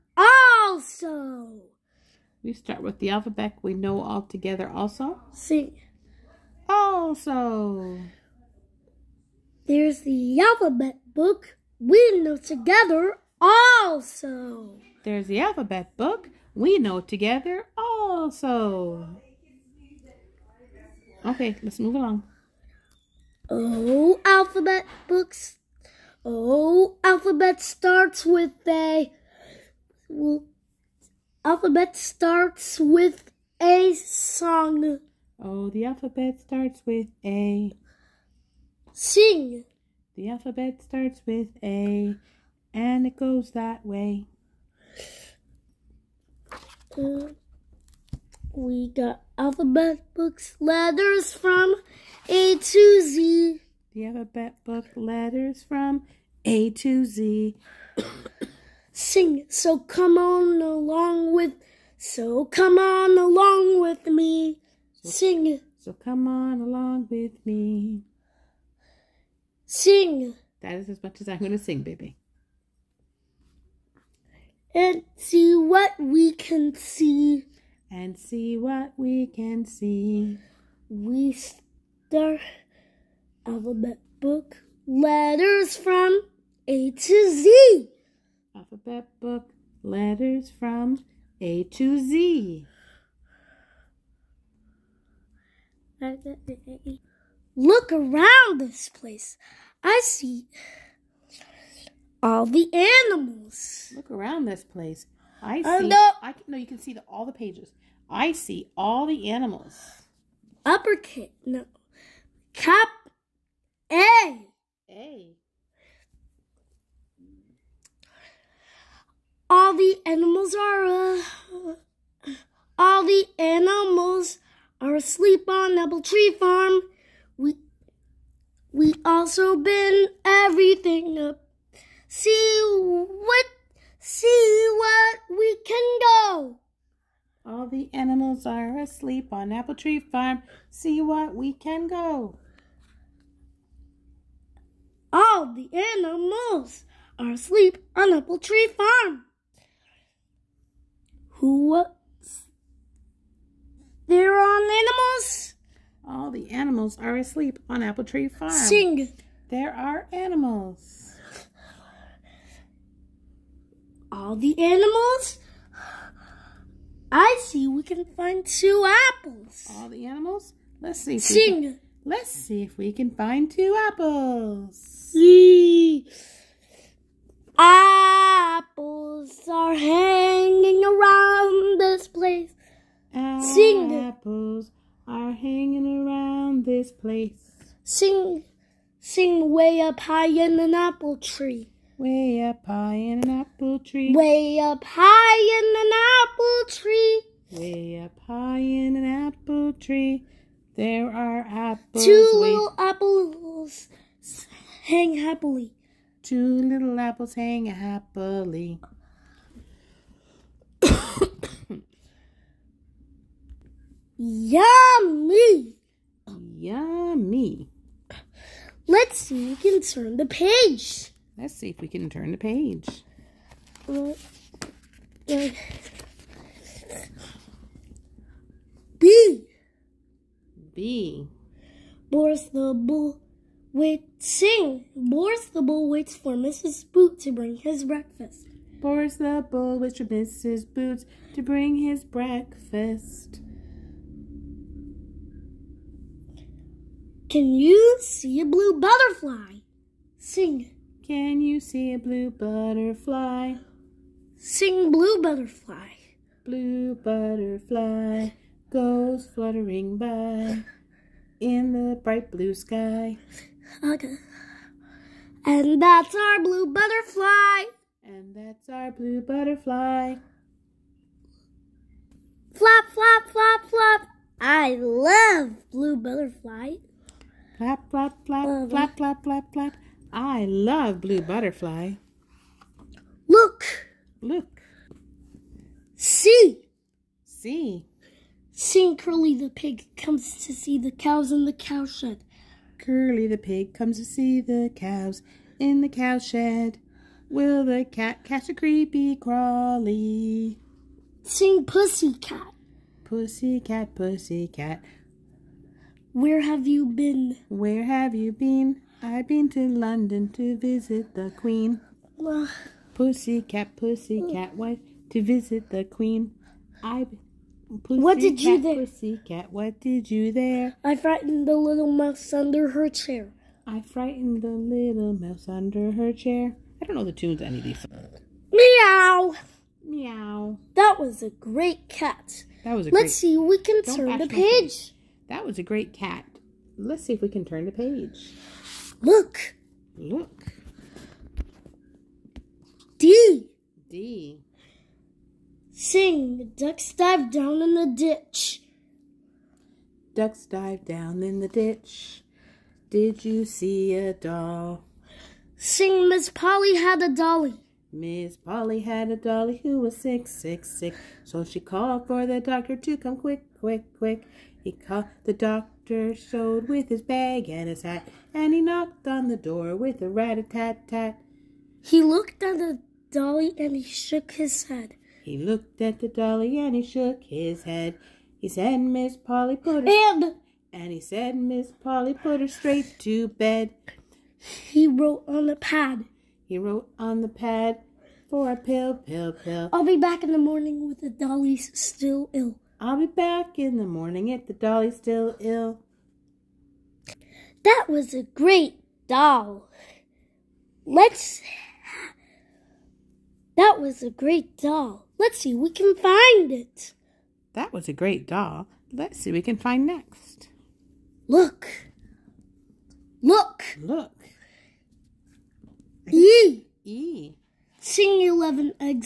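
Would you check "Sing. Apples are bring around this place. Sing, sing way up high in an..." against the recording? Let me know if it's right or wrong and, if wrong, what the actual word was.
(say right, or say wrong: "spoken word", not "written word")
wrong: "hanging", not "bring".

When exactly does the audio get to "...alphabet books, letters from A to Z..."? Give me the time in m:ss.
0:49.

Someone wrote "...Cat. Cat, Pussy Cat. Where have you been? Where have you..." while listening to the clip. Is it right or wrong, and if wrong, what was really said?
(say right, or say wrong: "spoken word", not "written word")
right.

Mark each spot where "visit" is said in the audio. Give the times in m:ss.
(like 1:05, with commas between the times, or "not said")
5:10, 5:15.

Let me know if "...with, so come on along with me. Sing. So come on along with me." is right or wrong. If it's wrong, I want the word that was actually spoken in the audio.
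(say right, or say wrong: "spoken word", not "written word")
right.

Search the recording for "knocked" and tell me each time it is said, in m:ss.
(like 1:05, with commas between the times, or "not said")
6:08.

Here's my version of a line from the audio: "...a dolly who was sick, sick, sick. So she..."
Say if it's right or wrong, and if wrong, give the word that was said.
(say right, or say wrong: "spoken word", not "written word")
right.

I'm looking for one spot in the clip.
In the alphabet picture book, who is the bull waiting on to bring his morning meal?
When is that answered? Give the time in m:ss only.
3:56.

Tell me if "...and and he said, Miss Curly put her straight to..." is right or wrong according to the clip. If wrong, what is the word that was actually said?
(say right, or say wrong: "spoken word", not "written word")
wrong: "Polly", not "Curly".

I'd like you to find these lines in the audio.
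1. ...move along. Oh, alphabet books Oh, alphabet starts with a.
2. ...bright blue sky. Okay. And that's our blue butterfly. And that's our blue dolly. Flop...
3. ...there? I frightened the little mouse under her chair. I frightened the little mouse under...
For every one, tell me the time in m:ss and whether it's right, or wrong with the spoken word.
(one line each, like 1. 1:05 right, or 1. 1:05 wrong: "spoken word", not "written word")
1. 0:21 right
2. 4:21 wrong: "butterfly", not "dolly"
3. 5:20 right.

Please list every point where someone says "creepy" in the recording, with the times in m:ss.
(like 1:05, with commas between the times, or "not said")
4:58.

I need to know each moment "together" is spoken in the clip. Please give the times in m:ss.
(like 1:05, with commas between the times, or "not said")
0:04, 0:12, 0:17.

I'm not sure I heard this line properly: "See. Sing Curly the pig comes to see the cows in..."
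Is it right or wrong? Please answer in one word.
right.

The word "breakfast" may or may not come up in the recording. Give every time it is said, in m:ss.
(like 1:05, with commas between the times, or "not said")
3:57, 4:02.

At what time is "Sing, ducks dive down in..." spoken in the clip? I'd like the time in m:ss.
5:45.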